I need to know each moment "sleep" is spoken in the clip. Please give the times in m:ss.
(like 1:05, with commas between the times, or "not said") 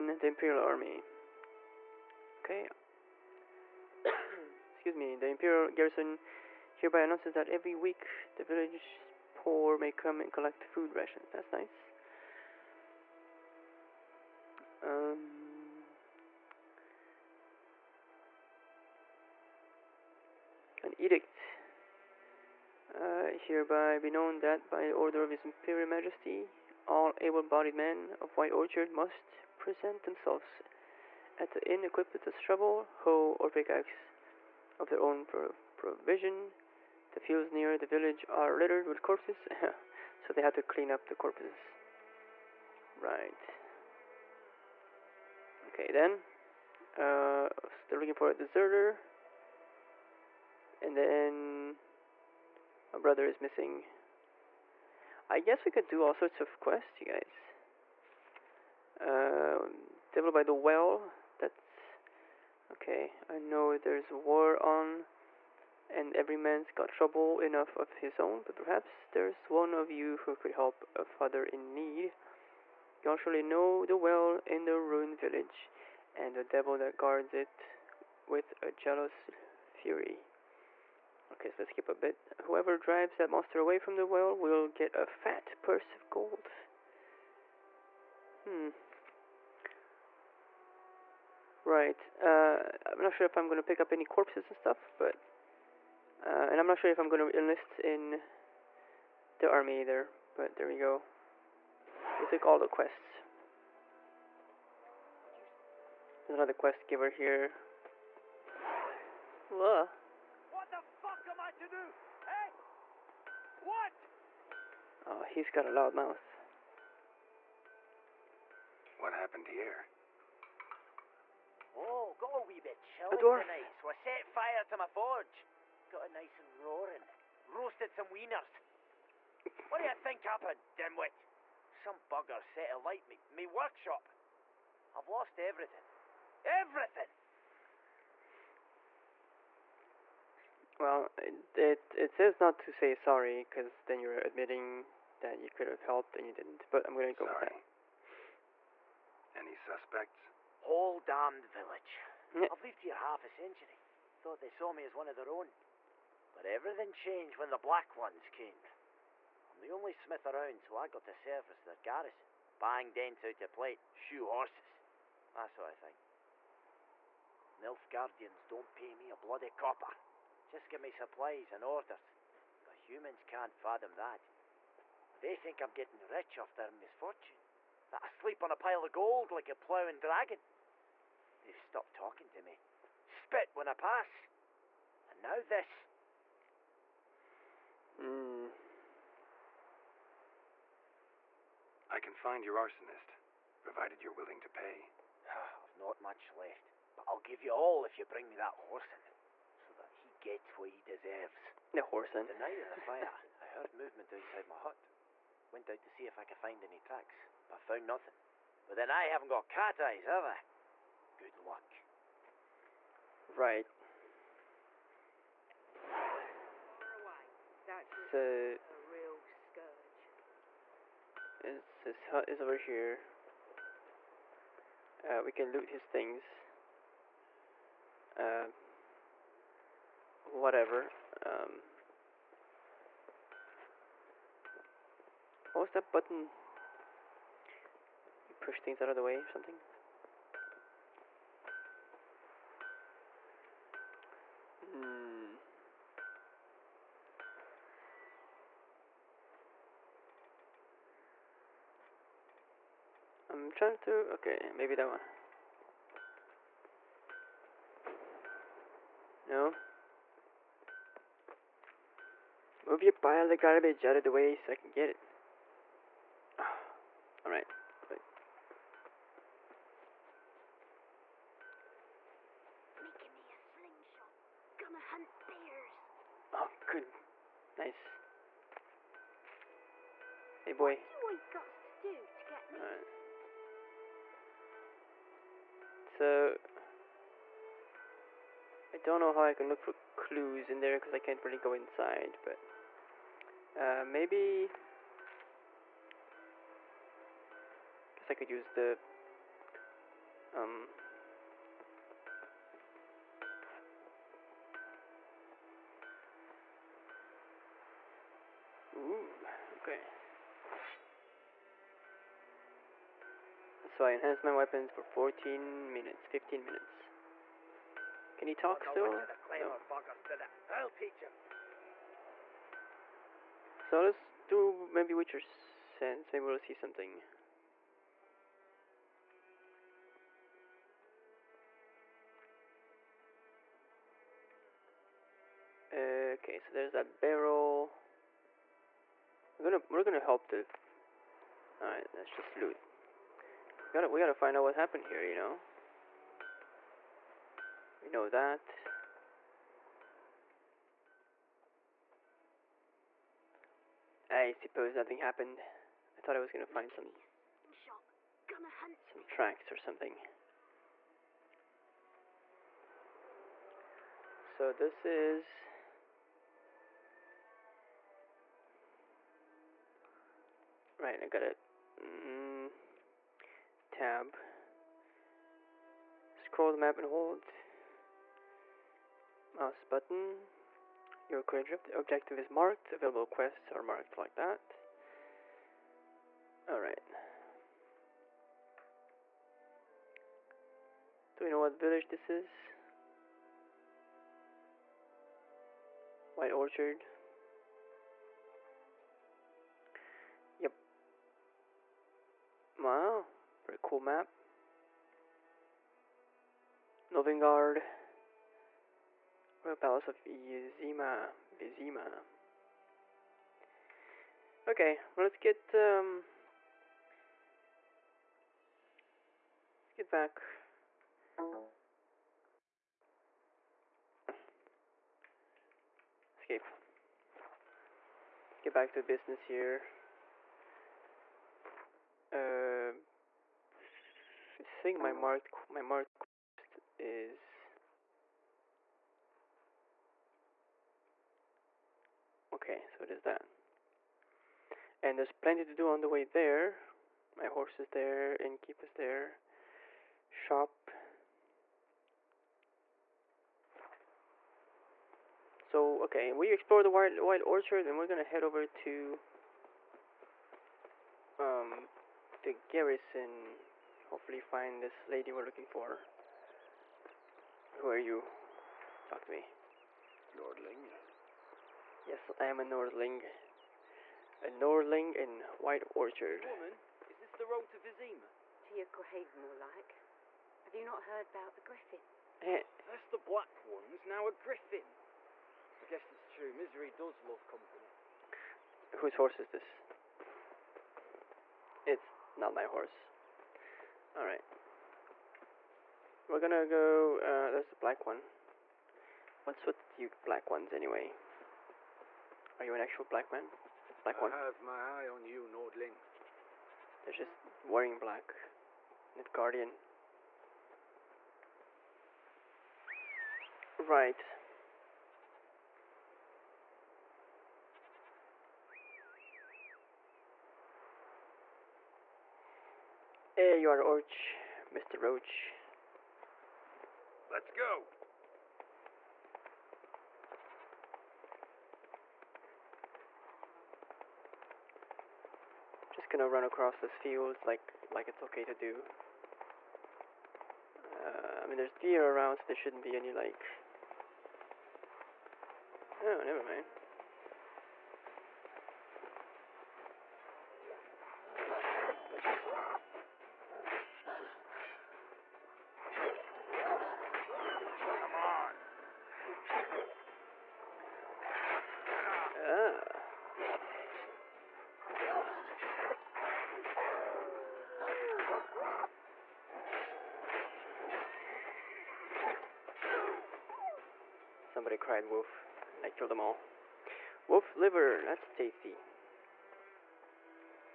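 2:58.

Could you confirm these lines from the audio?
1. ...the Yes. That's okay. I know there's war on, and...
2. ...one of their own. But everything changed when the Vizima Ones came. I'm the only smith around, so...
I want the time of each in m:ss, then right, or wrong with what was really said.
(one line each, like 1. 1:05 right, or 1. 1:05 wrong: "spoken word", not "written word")
1. 1:00 wrong: "Well", not "Yes"
2. 2:34 wrong: "Black", not "Vizima".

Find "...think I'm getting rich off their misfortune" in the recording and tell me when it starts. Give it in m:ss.
2:55.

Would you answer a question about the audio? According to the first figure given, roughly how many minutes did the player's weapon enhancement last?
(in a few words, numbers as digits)
14 minutes.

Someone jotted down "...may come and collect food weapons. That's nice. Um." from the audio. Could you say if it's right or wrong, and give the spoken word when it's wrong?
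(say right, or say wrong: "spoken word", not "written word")
wrong: "rations", not "weapons".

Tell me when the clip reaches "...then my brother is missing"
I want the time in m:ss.
0:50.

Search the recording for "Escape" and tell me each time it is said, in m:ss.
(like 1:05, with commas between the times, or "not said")
7:06.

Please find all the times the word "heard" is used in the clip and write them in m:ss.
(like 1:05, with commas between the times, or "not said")
3:23, 8:00.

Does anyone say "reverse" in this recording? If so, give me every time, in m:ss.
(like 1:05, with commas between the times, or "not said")
not said.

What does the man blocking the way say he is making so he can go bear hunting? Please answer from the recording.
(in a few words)
A slingshot.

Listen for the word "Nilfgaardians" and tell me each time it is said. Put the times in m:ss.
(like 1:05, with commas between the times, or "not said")
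2:47, 8:28.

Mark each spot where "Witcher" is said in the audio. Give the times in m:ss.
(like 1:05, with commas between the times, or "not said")
5:24.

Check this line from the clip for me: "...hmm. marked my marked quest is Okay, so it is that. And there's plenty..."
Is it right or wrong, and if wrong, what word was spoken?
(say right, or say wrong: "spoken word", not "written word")
right.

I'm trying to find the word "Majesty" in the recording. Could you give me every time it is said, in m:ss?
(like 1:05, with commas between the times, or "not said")
0:25.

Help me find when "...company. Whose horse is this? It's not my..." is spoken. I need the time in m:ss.
8:07.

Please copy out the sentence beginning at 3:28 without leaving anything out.
But then I haven't got cat eyes, have I?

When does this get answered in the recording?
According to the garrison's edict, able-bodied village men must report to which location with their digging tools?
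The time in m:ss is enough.
0:31.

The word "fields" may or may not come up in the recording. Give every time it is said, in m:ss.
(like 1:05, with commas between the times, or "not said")
0:37, 8:56.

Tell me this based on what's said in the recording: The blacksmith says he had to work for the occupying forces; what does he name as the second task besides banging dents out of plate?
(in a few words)
Shoe horses.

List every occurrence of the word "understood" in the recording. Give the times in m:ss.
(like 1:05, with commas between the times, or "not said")
not said.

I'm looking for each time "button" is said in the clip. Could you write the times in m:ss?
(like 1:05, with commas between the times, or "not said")
3:55, 6:19.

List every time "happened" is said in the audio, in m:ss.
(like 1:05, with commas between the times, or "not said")
1:59, 2:10, 5:44, 5:54.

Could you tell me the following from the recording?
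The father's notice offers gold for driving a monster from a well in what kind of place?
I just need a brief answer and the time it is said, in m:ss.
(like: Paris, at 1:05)
Ruined village, at 1:14.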